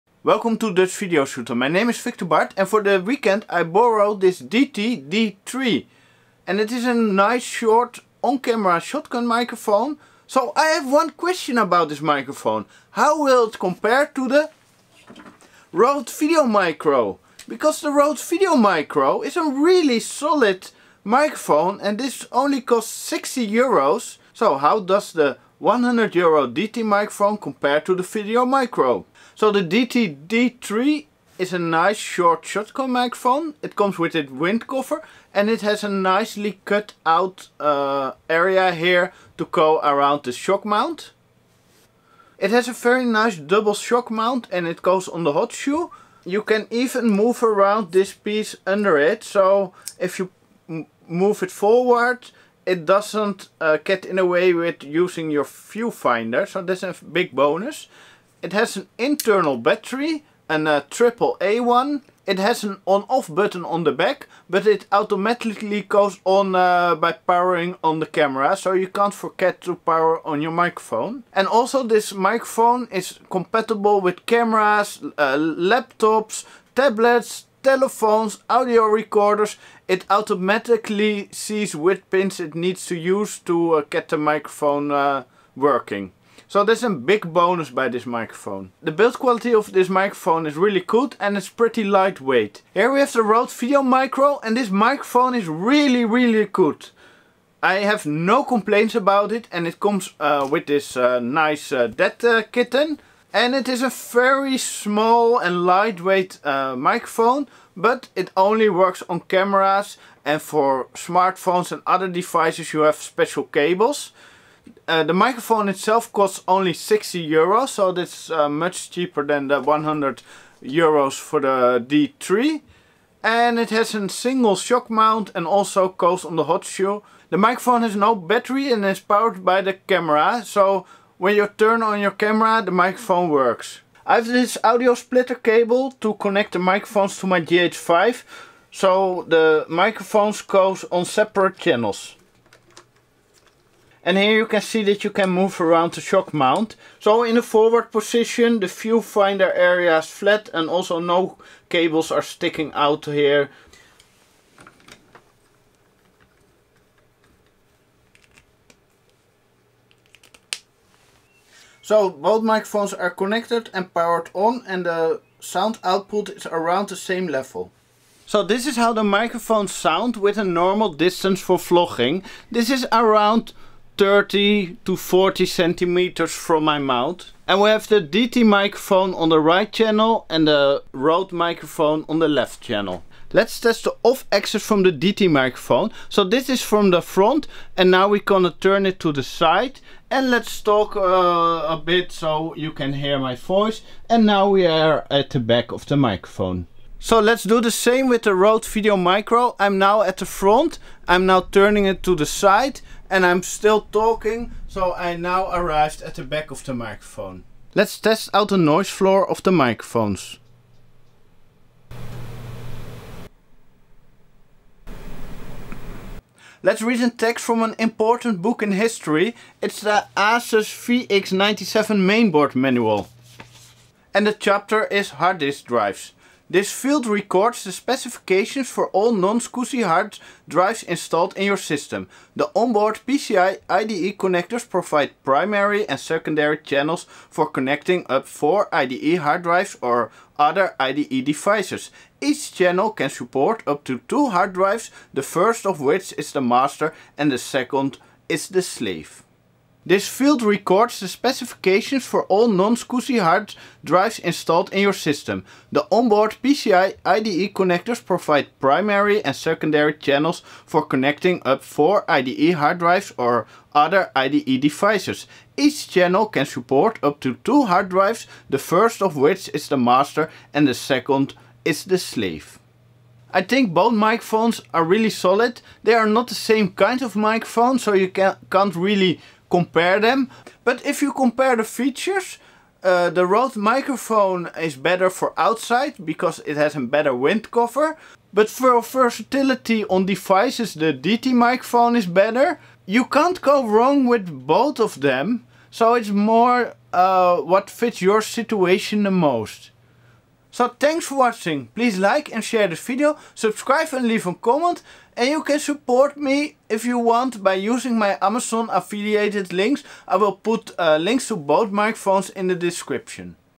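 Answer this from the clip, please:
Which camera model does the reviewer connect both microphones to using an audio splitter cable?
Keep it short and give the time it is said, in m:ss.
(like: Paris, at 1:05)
GH5, at 2:17.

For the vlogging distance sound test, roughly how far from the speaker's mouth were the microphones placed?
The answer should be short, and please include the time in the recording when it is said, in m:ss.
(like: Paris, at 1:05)
30 to 40 centimeters, at 2:54.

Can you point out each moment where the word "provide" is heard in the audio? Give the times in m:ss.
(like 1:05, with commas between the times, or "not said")
3:54, 4:18.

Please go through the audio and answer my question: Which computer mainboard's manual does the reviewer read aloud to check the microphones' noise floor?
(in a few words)
ASUS VX97.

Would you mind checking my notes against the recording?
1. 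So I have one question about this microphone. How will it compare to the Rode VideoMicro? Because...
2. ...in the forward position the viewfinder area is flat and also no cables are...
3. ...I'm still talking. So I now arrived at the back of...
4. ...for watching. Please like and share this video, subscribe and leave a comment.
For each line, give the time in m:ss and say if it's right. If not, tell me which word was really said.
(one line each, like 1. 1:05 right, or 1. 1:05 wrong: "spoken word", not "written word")
1. 0:10 right
2. 2:27 right
3. 3:23 right
4. 5:01 right.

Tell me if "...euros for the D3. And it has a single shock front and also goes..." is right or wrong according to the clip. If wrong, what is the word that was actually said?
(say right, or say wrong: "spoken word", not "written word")
wrong: "mount", not "front".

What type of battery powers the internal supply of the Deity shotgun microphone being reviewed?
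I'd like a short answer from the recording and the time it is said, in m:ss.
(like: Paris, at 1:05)
AAA, at 1:00.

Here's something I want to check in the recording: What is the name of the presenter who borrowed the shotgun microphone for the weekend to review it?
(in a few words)
Victor Bart.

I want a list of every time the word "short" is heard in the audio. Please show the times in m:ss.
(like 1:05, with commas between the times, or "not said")
0:07, 0:31.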